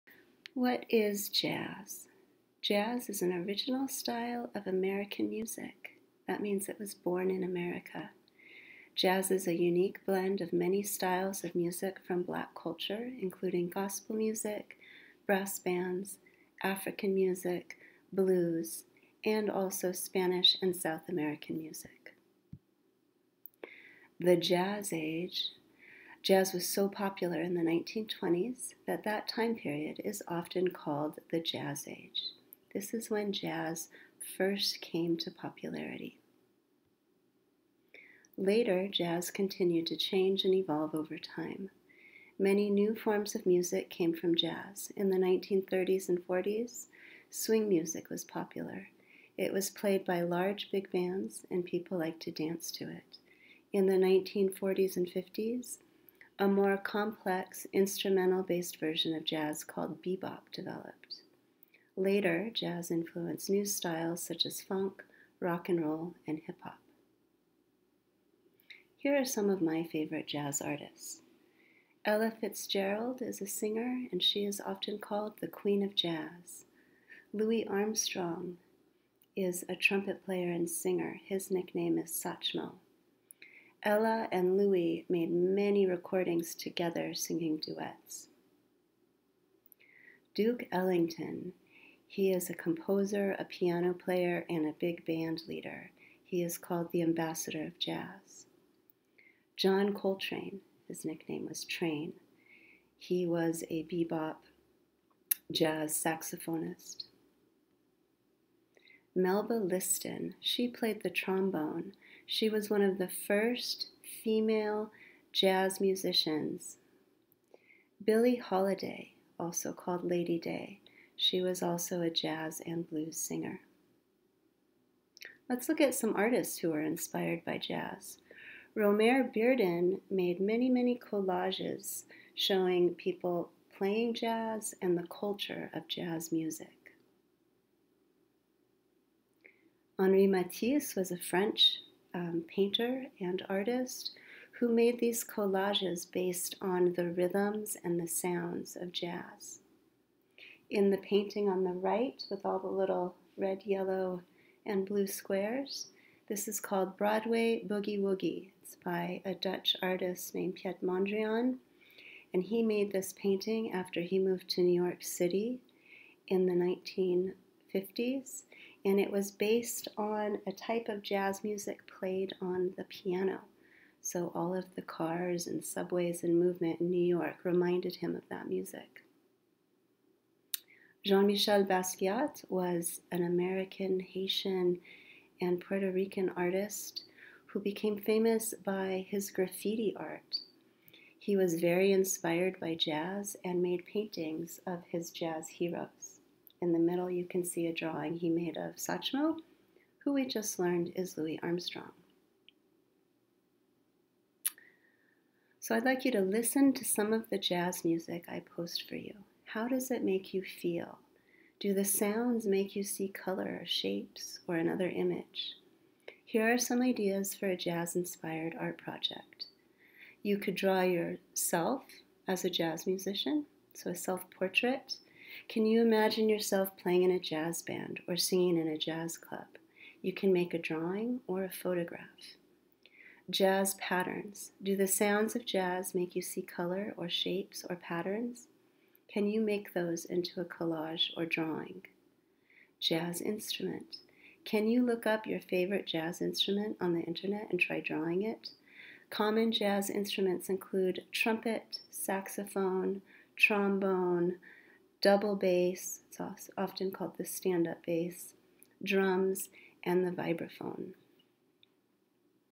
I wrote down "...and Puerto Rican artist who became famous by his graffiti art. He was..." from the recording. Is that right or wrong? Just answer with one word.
right.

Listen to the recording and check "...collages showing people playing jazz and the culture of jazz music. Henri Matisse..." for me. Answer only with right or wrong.
right.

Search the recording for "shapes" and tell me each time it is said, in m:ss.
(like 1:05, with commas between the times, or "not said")
3:33, 3:57.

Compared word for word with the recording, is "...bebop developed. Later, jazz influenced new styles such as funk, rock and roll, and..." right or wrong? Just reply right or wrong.
right.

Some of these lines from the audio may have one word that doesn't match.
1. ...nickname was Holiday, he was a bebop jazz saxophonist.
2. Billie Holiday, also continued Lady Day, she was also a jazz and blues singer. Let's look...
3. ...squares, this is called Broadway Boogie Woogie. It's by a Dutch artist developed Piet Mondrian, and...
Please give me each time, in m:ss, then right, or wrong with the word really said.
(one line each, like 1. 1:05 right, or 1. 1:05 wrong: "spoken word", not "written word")
1. 1:41 wrong: "Train", not "Holiday"
2. 1:58 wrong: "called", not "continued"
3. 2:35 wrong: "named", not "developed".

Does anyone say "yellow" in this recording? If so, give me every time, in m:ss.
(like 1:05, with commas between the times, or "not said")
2:33.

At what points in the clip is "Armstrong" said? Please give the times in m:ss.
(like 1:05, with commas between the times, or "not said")
1:17, 3:21.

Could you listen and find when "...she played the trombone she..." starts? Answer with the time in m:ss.
1:50.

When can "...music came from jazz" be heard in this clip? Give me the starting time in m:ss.
0:43.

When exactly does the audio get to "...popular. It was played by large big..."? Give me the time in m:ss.
0:48.